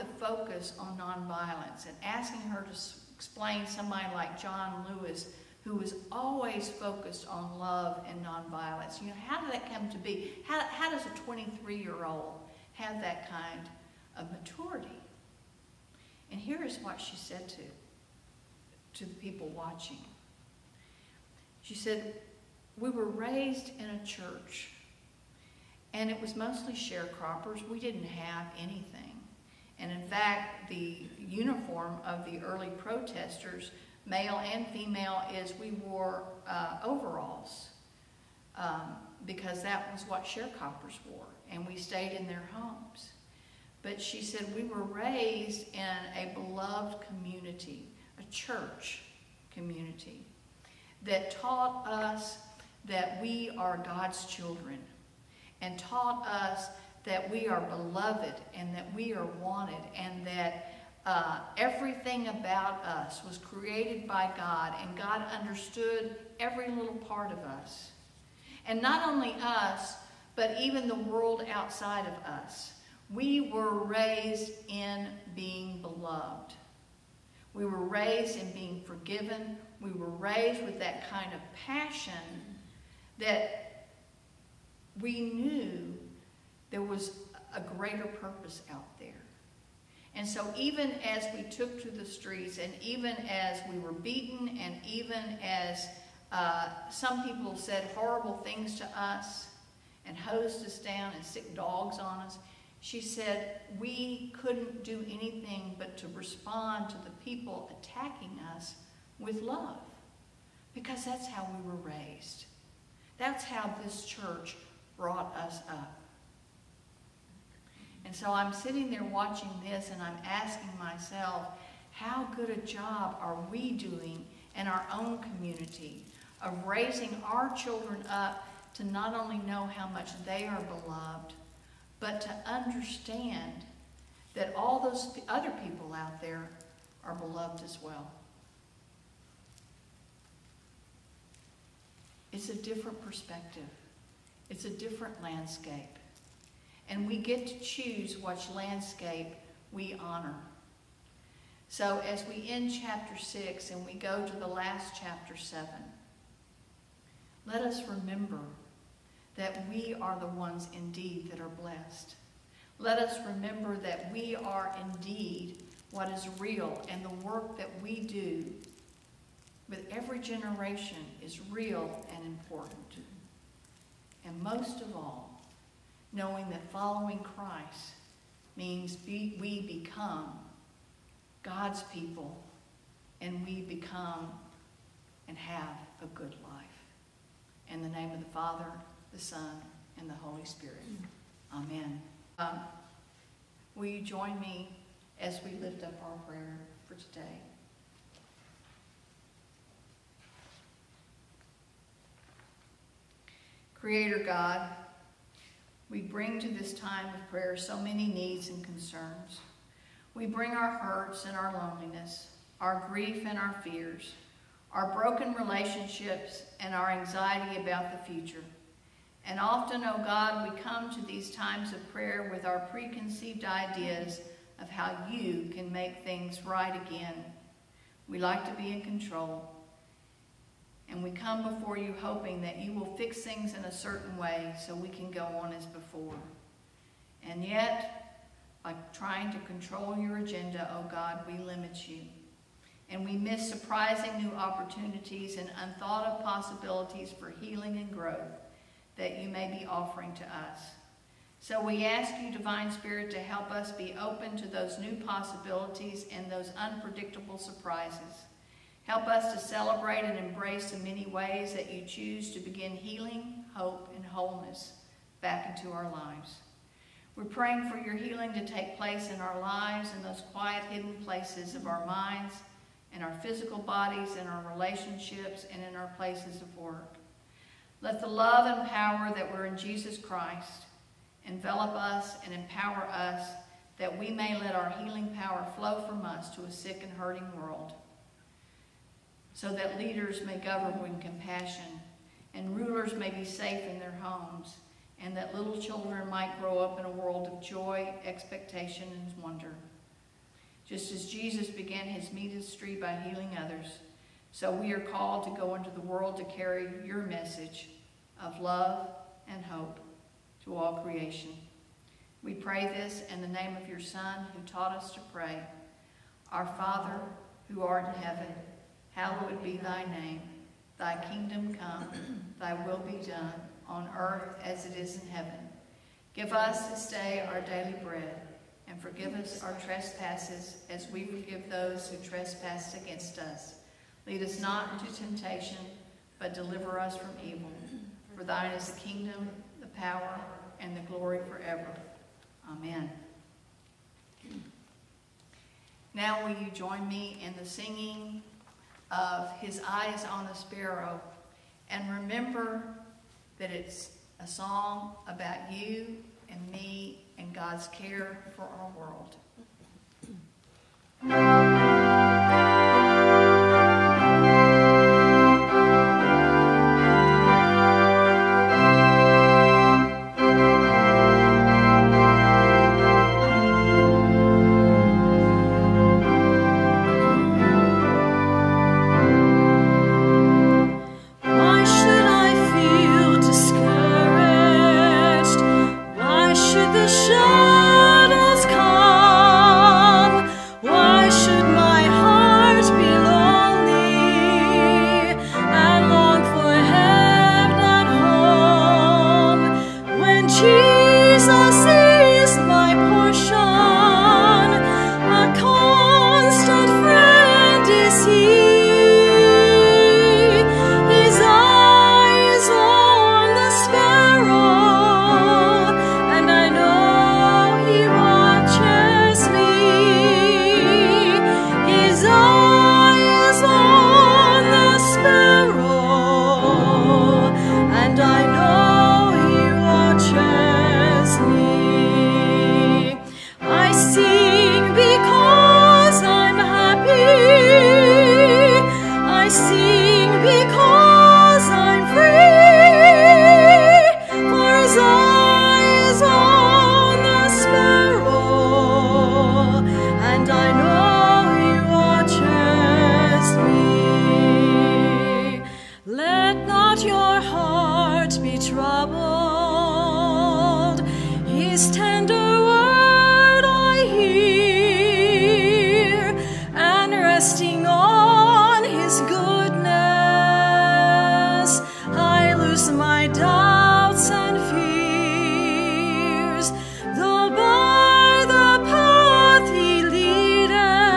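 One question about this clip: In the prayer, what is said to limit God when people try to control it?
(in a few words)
Your agenda.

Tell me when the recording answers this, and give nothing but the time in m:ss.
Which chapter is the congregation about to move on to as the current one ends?
2:34.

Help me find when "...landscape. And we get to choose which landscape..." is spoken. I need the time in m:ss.
2:25.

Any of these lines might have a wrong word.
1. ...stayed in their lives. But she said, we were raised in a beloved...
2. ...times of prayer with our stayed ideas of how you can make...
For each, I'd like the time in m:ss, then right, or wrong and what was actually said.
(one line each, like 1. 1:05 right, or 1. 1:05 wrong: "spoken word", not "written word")
1. 0:41 wrong: "homes", not "lives"
2. 3:41 wrong: "preconceived", not "stayed".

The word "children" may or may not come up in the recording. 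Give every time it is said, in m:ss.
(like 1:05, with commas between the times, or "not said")
0:54, 2:07, 4:55.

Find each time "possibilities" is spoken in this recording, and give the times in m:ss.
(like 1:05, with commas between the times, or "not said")
4:06, 4:15.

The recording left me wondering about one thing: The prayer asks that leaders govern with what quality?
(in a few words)
Compassion.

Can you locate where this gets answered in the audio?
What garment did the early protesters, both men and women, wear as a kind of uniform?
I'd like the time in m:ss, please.
0:36.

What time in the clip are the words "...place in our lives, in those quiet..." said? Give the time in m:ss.
4:28.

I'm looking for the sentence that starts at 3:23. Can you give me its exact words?
Creator God, we bring to this time of prayer so many needs and concerns.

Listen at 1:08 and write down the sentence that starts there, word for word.
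And not only us, but even the world outside of us.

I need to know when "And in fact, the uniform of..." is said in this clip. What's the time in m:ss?
0:29.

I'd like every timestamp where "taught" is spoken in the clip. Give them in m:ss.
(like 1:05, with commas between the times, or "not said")
0:51, 0:55, 5:14.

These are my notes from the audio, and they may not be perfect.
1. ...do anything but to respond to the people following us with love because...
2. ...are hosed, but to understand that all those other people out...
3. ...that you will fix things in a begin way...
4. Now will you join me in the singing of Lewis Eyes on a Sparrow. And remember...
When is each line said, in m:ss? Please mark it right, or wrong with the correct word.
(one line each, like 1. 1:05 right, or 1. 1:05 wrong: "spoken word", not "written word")
1. 1:44 wrong: "attacking", not "following"
2. 2:10 wrong: "beloved", not "hosed"
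3. 3:52 wrong: "certain", not "begin"
4. 5:45 wrong: "His", not "Lewis".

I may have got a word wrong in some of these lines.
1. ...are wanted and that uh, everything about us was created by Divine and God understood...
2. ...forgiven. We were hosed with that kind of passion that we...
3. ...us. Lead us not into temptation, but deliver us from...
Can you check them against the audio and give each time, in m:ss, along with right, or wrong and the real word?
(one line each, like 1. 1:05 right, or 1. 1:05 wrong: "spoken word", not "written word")
1. 0:59 wrong: "God", not "Divine"
2. 1:18 wrong: "raised", not "hosed"
3. 5:33 right.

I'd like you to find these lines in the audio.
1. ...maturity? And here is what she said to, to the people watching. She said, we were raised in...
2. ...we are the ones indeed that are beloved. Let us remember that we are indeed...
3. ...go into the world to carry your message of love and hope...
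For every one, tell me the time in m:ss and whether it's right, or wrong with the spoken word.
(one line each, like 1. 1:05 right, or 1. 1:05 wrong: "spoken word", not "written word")
1. 0:14 right
2. 2:39 wrong: "blessed", not "beloved"
3. 5:05 right.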